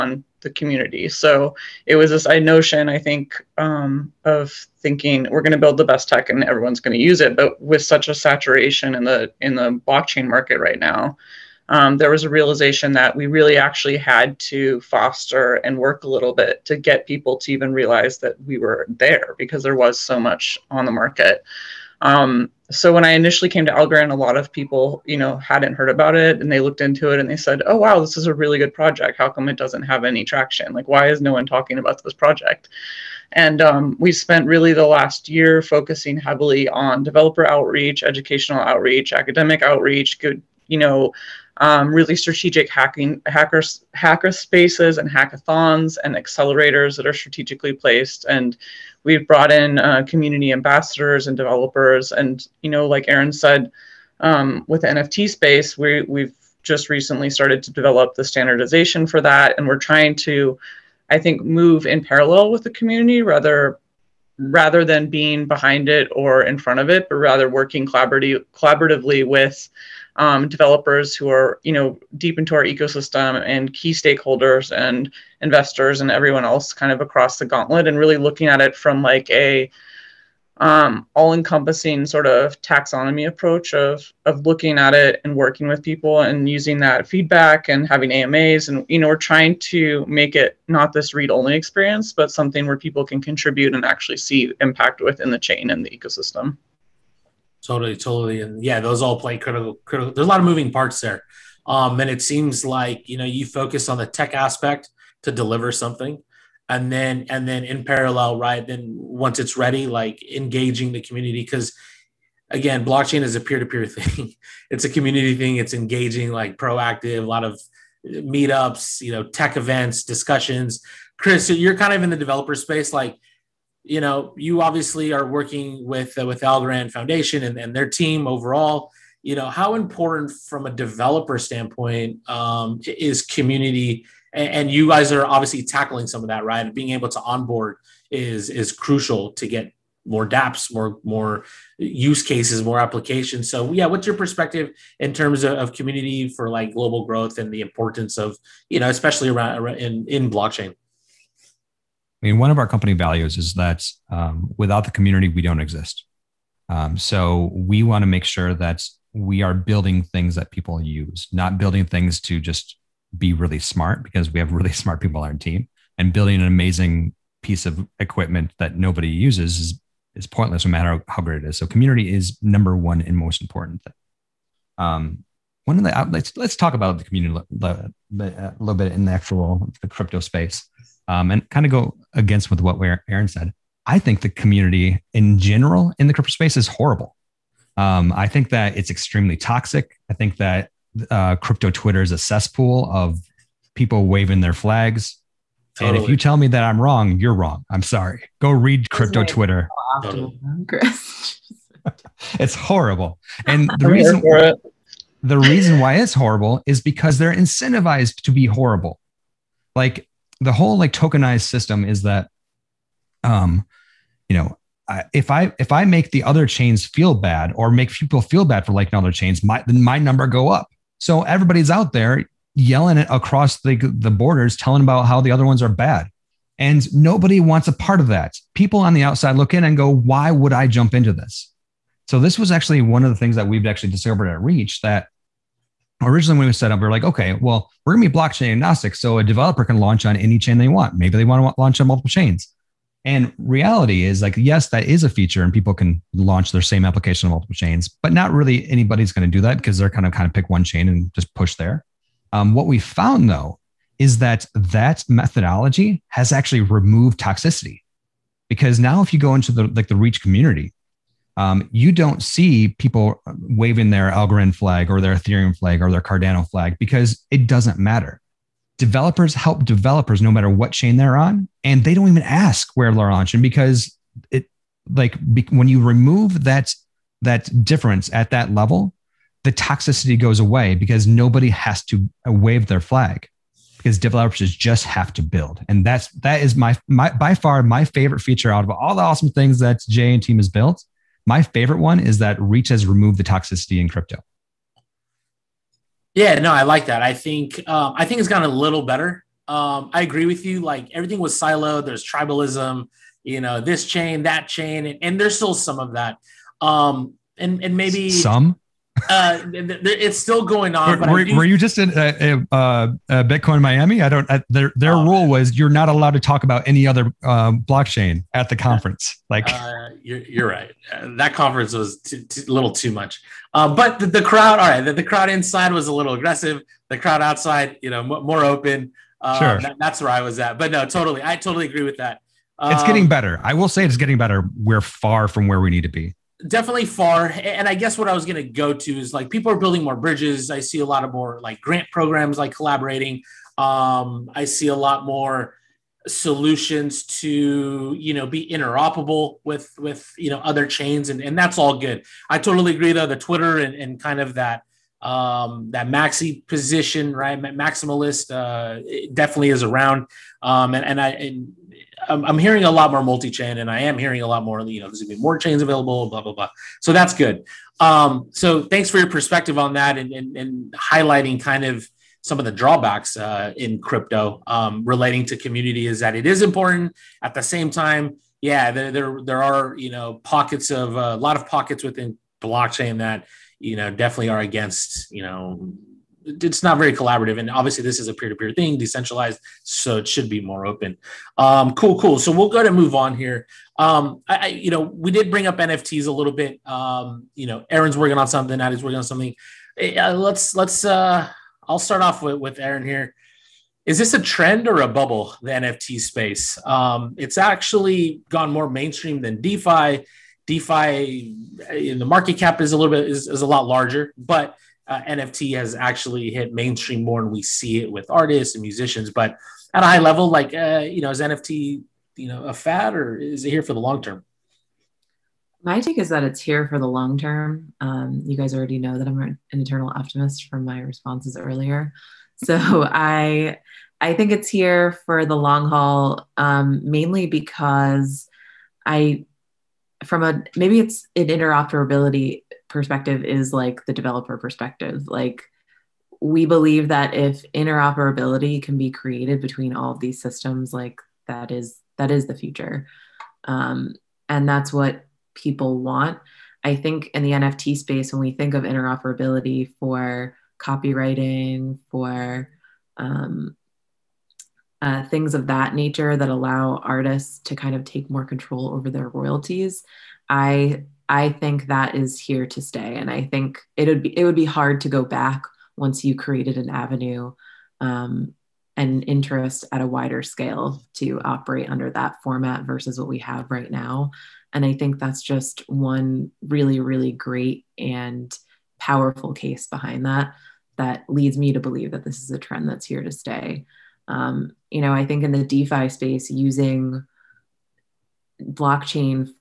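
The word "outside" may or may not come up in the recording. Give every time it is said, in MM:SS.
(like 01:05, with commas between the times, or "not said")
03:49, 05:27.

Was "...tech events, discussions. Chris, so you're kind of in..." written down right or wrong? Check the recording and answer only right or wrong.
right.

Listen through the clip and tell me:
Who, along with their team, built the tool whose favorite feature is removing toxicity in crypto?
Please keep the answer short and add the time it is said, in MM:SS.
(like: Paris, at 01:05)
Jay, at 04:49.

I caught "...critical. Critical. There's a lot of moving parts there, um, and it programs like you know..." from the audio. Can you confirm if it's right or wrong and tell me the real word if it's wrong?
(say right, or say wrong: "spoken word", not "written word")
wrong: "seems", not "programs".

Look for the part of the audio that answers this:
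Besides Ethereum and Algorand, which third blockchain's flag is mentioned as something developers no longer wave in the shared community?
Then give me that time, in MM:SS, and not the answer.
04:26.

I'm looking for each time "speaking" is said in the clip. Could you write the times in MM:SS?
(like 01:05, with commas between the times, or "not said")
not said.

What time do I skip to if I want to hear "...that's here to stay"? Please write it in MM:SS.
08:12.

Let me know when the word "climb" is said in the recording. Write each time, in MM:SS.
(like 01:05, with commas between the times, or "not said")
not said.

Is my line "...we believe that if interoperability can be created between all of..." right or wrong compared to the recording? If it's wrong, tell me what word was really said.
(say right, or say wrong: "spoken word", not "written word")
right.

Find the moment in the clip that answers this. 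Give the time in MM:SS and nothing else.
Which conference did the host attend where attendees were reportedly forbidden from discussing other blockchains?
05:13.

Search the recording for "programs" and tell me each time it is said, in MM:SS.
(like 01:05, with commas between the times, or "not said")
05:41.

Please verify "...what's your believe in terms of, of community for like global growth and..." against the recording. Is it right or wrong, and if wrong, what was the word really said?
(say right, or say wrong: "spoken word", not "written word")
wrong: "perspective", not "believe".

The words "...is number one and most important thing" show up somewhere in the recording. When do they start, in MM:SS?
02:52.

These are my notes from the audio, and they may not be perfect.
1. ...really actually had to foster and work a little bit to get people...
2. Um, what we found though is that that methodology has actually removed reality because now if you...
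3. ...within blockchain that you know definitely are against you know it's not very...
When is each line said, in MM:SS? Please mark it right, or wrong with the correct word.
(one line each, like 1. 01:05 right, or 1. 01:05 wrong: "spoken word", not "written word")
1. 00:13 right
2. 04:12 wrong: "toxicity", not "reality"
3. 06:21 right.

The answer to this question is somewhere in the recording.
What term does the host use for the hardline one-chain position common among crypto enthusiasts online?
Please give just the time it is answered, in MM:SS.
05:57.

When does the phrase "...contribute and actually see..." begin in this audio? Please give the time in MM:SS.
01:33.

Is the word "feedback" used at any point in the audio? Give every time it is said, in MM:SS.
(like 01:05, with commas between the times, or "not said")
01:27.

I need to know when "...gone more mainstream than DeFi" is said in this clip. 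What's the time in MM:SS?
06:48.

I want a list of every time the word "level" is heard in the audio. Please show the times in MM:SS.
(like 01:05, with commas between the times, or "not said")
04:38, 06:59.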